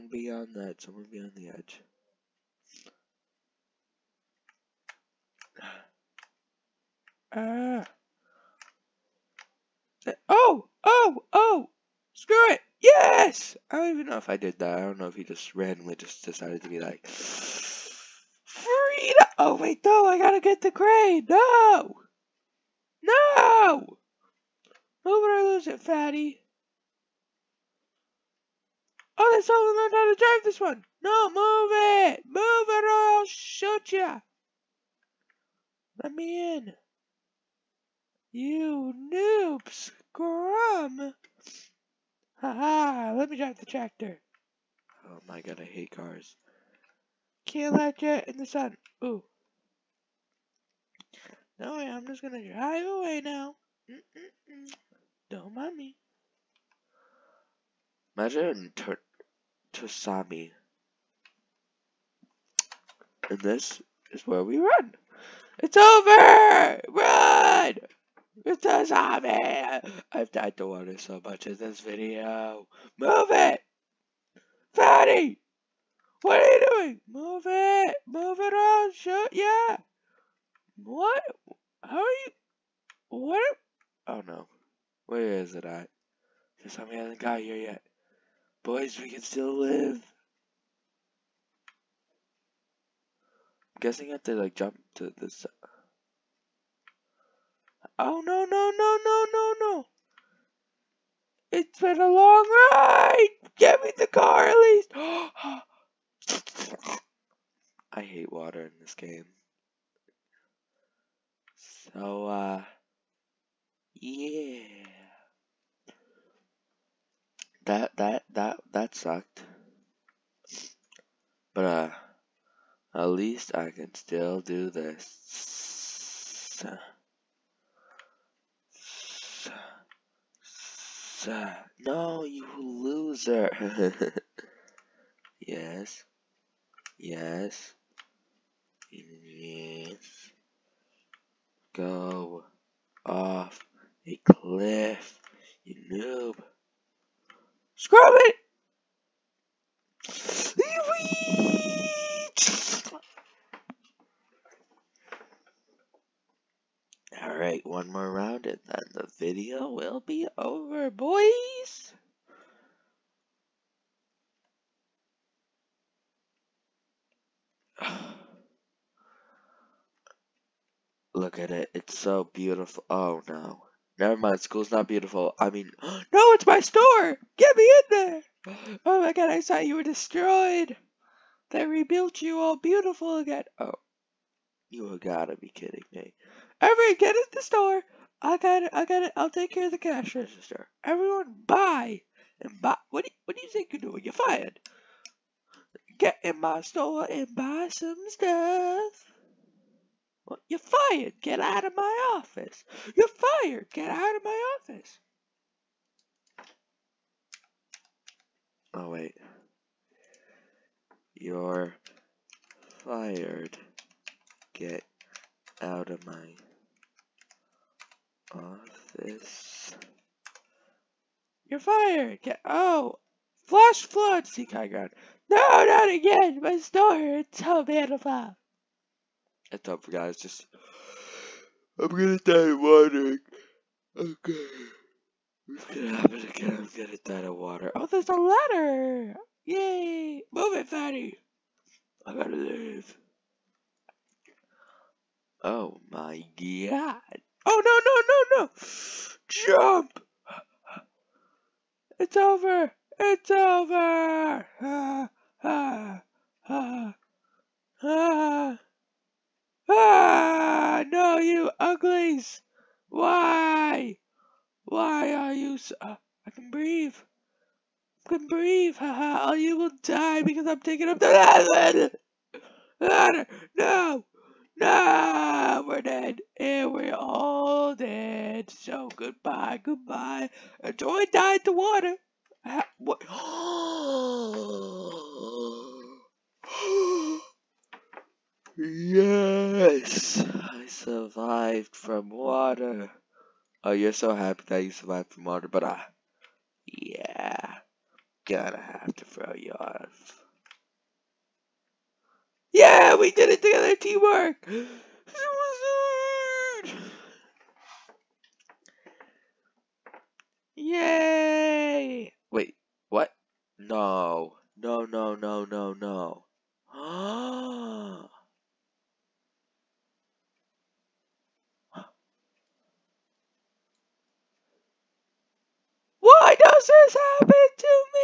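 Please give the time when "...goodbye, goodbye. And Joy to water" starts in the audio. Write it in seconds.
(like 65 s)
278 s.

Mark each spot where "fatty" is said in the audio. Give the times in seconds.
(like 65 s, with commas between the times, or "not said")
25 s, 74 s, 240 s.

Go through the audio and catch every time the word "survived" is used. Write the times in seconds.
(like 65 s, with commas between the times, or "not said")
290 s, 294 s.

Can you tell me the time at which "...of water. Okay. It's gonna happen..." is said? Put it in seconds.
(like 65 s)
232 s.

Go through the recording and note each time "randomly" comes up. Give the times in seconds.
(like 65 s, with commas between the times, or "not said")
15 s.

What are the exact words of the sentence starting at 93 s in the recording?
I'm guessing I have to like jump to this.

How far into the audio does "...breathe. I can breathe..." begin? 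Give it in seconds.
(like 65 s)
266 s.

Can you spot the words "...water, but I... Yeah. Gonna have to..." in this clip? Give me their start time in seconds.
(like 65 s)
295 s.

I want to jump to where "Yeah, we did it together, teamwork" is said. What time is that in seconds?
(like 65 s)
302 s.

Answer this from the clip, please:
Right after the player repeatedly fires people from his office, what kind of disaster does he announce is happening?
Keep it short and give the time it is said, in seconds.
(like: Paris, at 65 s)
flash flood, at 223 s.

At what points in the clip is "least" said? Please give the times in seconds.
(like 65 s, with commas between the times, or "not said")
104 s, 123 s.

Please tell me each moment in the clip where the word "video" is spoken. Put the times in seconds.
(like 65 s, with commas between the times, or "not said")
71 s, 159 s.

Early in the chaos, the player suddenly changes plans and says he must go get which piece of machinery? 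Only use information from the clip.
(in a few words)
crane.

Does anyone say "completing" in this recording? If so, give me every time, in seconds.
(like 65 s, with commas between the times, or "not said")
not said.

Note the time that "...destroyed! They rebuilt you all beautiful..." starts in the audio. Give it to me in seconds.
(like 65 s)
179 s.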